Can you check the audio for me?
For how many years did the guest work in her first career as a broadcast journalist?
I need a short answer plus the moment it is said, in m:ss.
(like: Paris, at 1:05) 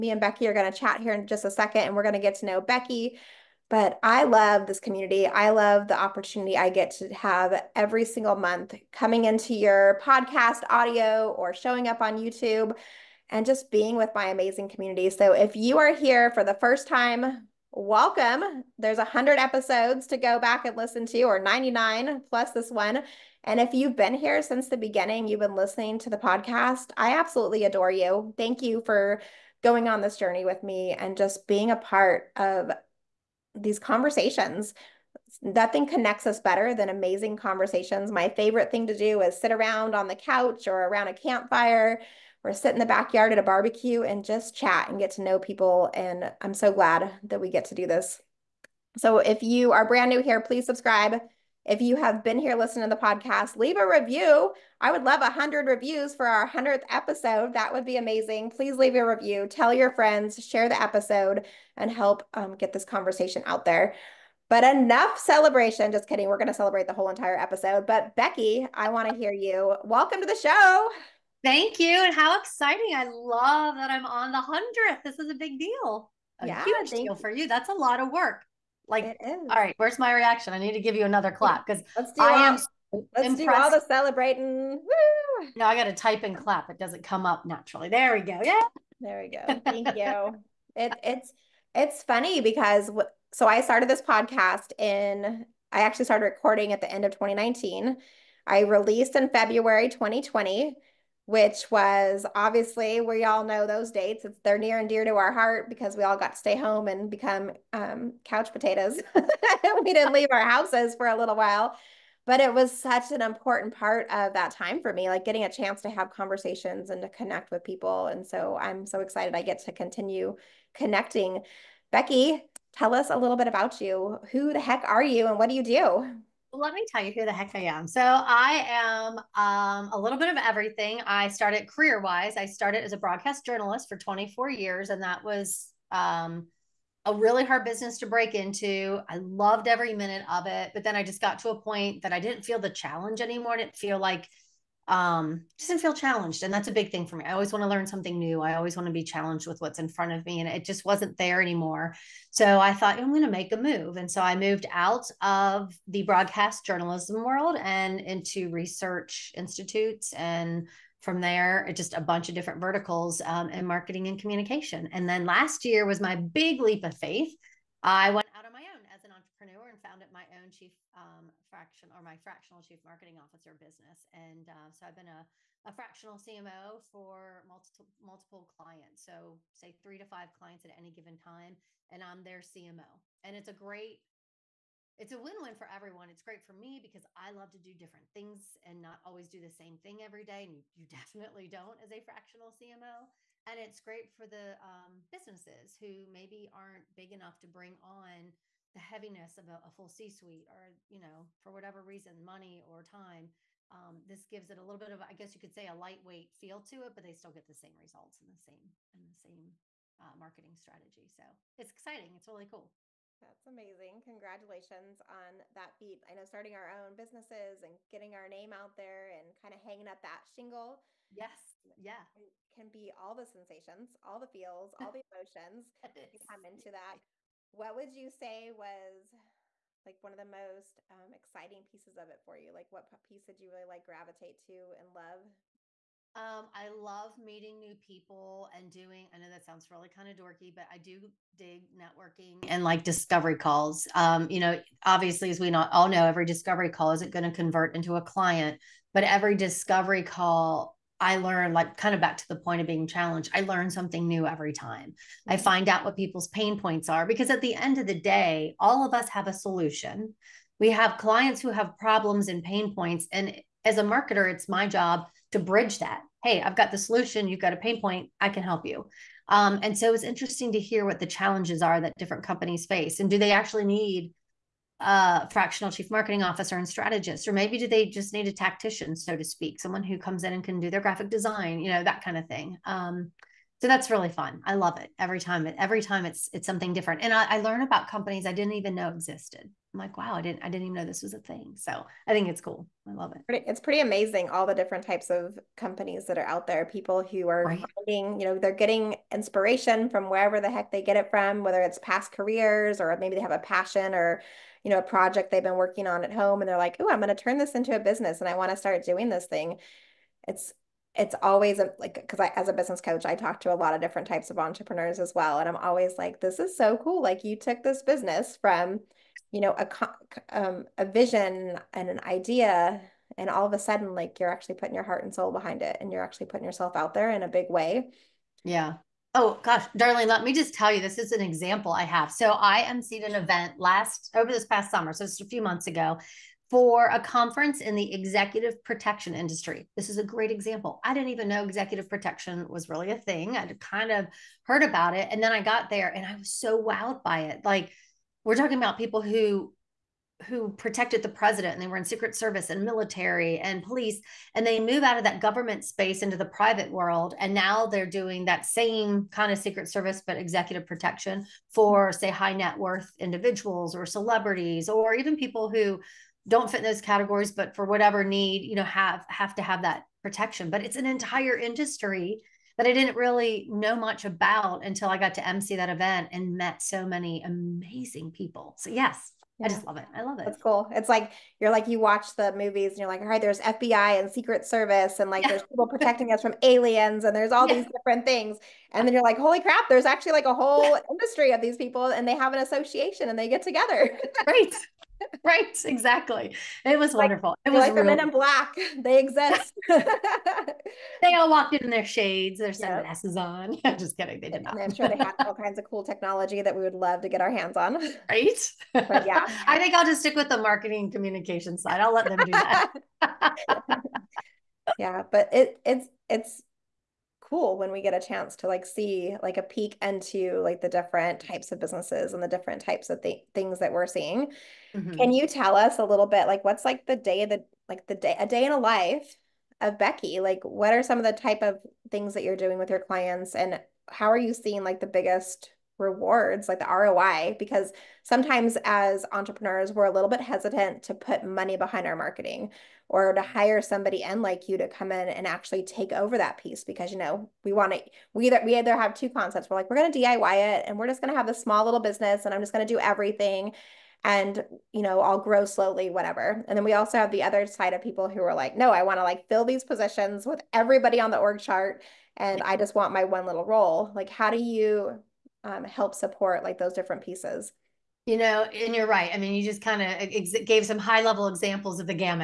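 24, at 2:13.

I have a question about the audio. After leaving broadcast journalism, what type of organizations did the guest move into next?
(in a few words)
research institutes.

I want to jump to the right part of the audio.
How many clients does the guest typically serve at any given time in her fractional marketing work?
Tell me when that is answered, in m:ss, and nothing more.
2:59.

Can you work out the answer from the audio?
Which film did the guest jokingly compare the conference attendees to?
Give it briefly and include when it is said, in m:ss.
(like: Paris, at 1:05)
Men in Black, at 6:37.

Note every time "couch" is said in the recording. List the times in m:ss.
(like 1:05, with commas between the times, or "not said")
0:40, 1:48.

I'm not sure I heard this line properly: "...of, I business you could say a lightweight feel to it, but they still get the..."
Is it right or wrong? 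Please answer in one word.
wrong.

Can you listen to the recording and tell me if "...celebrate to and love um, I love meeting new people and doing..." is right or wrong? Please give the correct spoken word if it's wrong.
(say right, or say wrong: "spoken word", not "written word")
wrong: "gravitate", not "celebrate".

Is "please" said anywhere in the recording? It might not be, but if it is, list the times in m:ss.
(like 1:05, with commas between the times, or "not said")
0:50, 0:58.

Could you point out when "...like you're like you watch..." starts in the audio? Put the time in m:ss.
6:20.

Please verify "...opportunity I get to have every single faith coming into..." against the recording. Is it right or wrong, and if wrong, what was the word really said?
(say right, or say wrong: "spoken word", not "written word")
wrong: "month", not "faith".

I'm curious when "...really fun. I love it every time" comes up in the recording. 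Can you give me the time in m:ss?
4:43.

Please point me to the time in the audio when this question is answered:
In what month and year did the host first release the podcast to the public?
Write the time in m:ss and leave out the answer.
1:39.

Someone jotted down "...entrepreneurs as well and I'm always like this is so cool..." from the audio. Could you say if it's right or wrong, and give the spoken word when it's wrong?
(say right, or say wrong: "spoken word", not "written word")
right.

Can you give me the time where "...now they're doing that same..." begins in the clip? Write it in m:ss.
5:57.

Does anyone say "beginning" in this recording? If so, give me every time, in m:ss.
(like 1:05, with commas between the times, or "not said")
0:24.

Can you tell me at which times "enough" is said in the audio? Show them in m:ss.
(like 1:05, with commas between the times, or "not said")
1:04, 3:17.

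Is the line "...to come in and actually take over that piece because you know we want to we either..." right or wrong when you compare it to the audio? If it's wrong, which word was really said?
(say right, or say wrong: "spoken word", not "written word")
right.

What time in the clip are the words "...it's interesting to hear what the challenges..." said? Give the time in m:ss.
4:29.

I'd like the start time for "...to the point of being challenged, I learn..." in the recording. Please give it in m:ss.
4:12.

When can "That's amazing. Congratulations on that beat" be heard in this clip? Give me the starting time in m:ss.
3:33.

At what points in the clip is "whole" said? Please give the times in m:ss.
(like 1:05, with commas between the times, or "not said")
1:06, 6:30.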